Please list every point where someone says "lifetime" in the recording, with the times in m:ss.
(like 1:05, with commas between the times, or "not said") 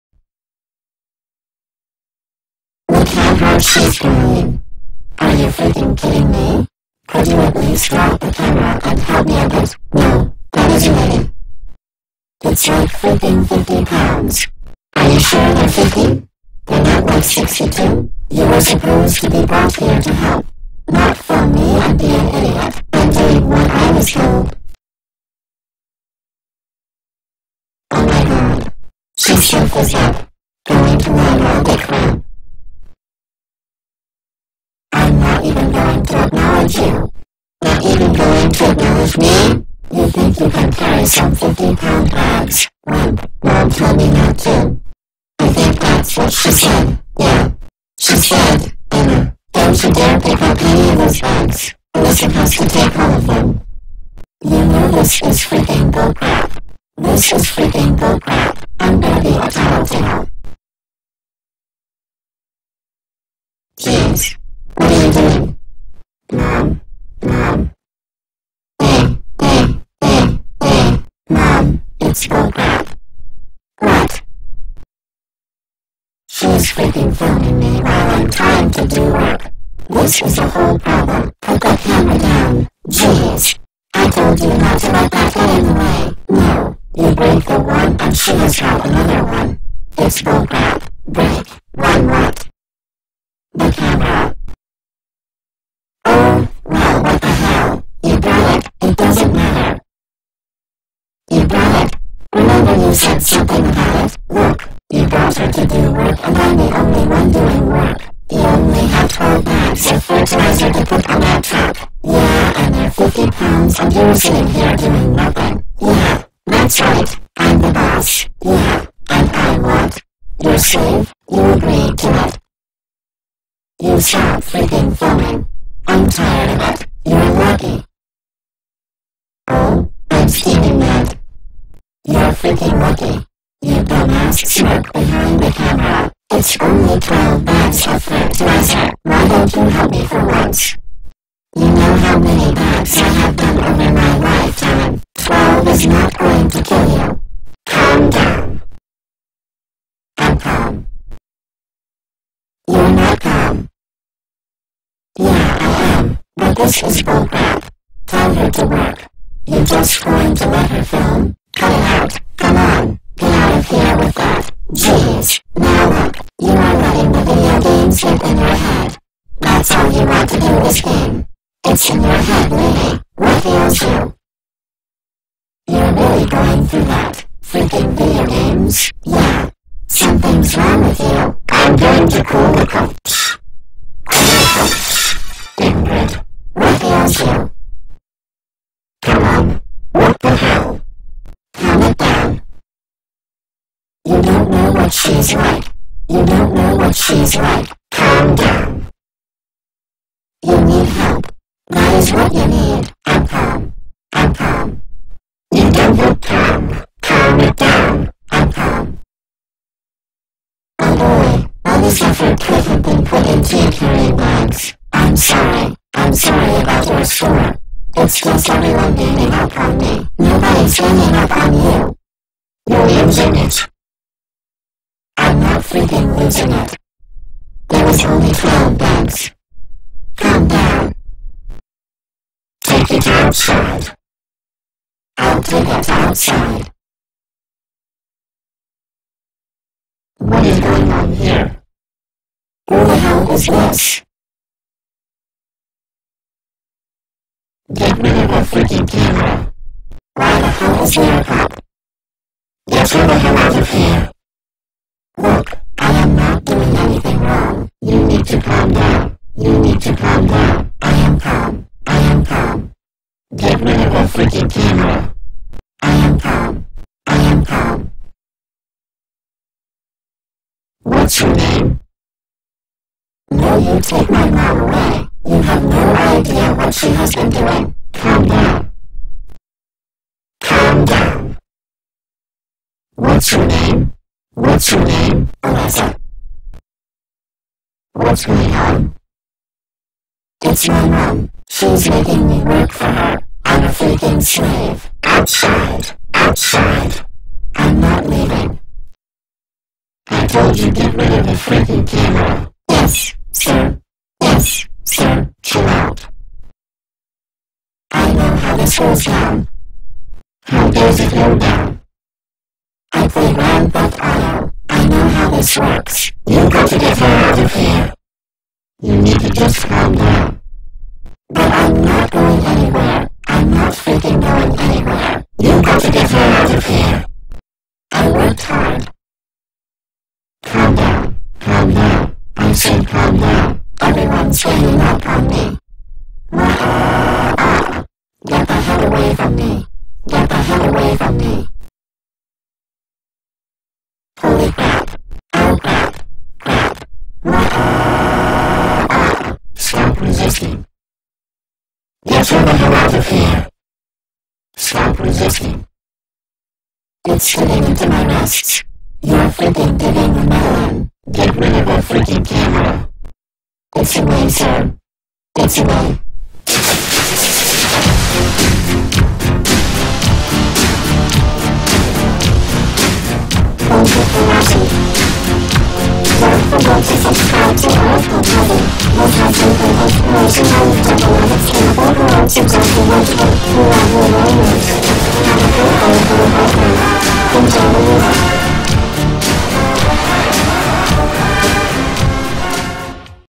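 2:24.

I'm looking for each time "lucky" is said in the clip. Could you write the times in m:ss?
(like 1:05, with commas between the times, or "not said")
2:07, 2:12.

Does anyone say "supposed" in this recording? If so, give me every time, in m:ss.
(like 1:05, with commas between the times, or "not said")
0:18, 0:52.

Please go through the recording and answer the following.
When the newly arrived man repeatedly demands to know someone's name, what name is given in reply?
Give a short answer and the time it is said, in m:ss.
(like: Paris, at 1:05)
Alexa, at 4:45.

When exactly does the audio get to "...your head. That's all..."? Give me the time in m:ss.
2:48.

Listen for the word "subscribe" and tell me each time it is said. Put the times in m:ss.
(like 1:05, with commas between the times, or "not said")
6:17.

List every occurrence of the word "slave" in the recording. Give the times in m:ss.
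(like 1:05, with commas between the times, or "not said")
2:00, 4:54.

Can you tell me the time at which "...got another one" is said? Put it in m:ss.
1:28.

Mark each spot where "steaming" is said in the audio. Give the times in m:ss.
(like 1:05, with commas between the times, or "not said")
2:10.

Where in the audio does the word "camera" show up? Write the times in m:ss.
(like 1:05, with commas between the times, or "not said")
0:08, 1:33, 2:15, 4:08, 4:24, 5:01, 6:02.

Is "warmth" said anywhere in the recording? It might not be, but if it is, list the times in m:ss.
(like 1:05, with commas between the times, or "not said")
not said.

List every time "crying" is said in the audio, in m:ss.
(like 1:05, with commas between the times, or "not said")
0:03.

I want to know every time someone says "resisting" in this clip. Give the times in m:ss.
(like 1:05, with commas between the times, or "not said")
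5:50, 5:54.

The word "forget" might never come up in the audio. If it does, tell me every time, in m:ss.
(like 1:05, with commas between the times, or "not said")
6:16.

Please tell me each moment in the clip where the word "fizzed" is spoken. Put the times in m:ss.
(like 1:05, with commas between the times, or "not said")
0:29.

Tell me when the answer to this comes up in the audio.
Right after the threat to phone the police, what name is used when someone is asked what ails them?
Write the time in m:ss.
3:05.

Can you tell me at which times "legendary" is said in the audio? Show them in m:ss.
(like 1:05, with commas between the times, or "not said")
not said.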